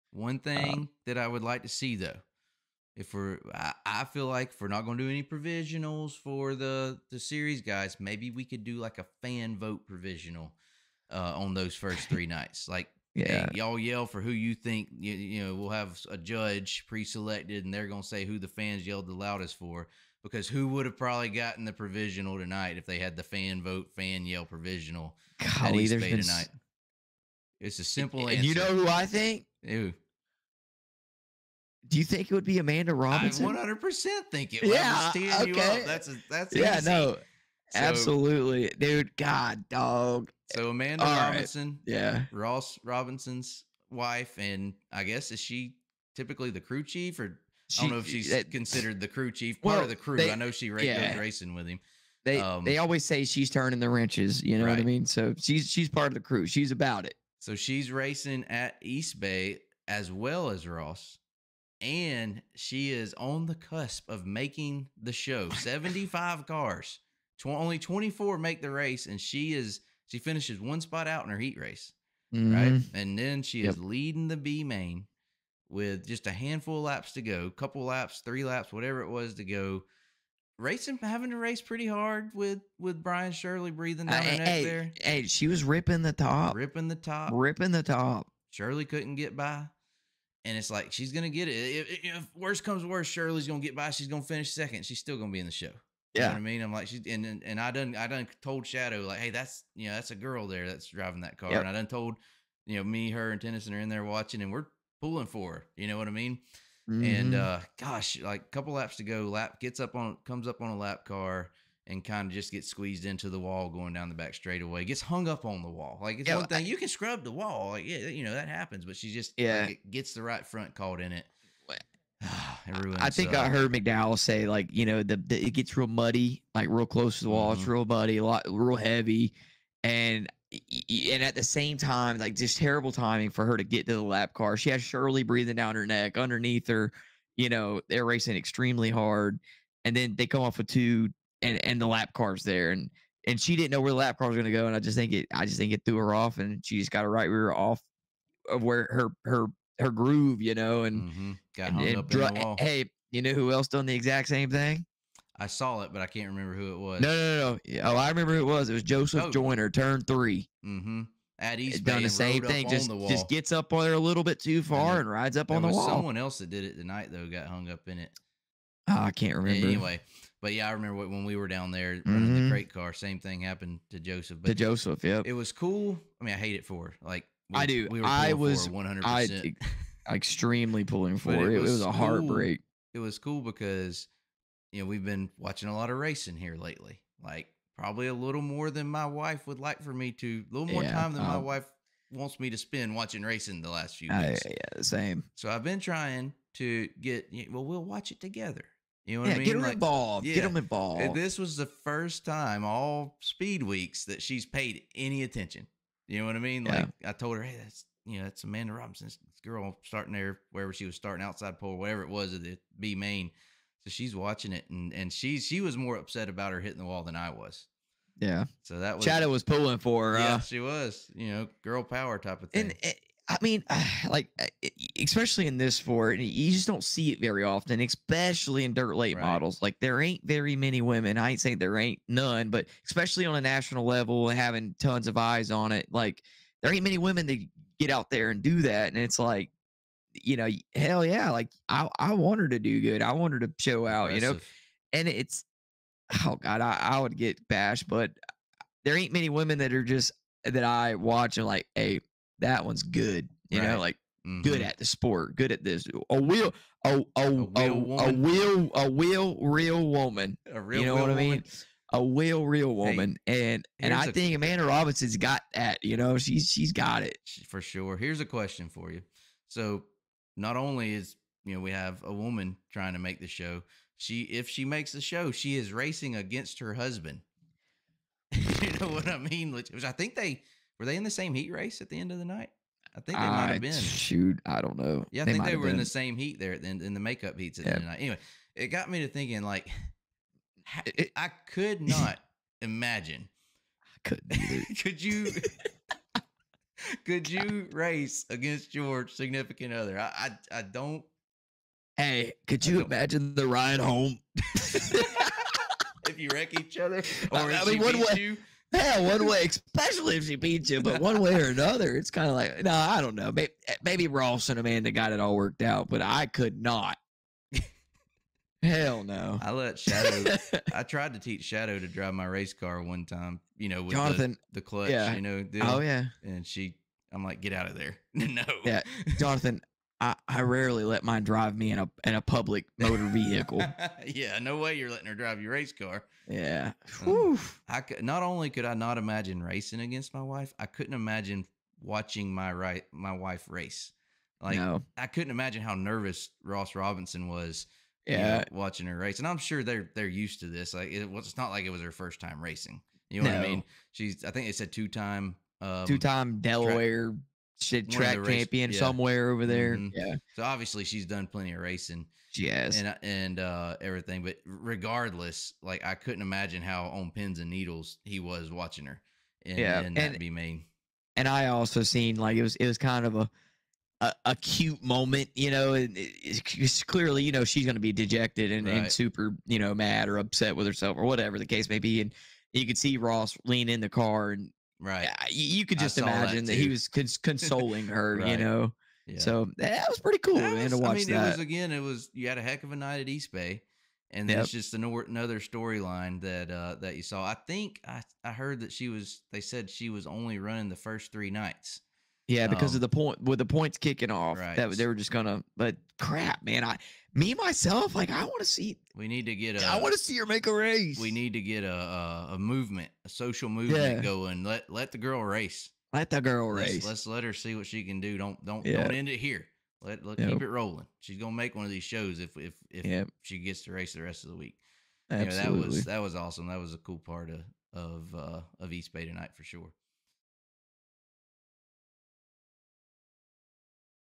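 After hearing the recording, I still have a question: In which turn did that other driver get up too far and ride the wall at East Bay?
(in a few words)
Turn 3.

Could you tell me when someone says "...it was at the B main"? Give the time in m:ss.
3:32.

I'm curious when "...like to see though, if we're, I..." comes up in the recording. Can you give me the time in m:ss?
0:01.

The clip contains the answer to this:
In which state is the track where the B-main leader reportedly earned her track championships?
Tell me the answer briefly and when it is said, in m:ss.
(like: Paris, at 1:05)
Delaware, at 5:56.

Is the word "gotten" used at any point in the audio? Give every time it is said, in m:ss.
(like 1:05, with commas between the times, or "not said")
0:21.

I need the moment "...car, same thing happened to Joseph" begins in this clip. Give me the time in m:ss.
2:52.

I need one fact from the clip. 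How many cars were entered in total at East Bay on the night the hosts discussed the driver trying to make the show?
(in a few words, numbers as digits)
75.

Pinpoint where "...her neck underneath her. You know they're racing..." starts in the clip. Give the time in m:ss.
2:15.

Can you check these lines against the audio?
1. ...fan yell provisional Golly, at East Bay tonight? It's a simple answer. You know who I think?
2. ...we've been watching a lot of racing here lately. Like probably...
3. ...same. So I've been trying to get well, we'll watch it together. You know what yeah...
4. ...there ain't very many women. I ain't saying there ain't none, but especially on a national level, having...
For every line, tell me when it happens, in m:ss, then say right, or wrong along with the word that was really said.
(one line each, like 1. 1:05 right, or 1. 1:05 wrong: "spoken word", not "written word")
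1. 0:23 right
2. 3:04 right
3. 3:14 right
4. 3:49 right.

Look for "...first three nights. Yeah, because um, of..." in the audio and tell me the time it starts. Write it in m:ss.
6:40.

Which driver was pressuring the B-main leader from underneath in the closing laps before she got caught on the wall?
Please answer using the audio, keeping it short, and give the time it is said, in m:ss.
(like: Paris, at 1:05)
Brian Shirley, at 1:23.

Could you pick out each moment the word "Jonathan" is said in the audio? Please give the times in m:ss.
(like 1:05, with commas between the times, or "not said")
5:23, 5:29.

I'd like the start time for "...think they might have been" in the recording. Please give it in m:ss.
4:43.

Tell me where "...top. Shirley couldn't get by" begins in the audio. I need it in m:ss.
1:27.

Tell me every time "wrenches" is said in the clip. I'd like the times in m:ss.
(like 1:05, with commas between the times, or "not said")
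0:53.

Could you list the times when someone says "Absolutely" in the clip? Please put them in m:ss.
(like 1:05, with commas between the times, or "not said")
0:37, 7:05.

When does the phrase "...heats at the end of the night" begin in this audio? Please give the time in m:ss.
4:47.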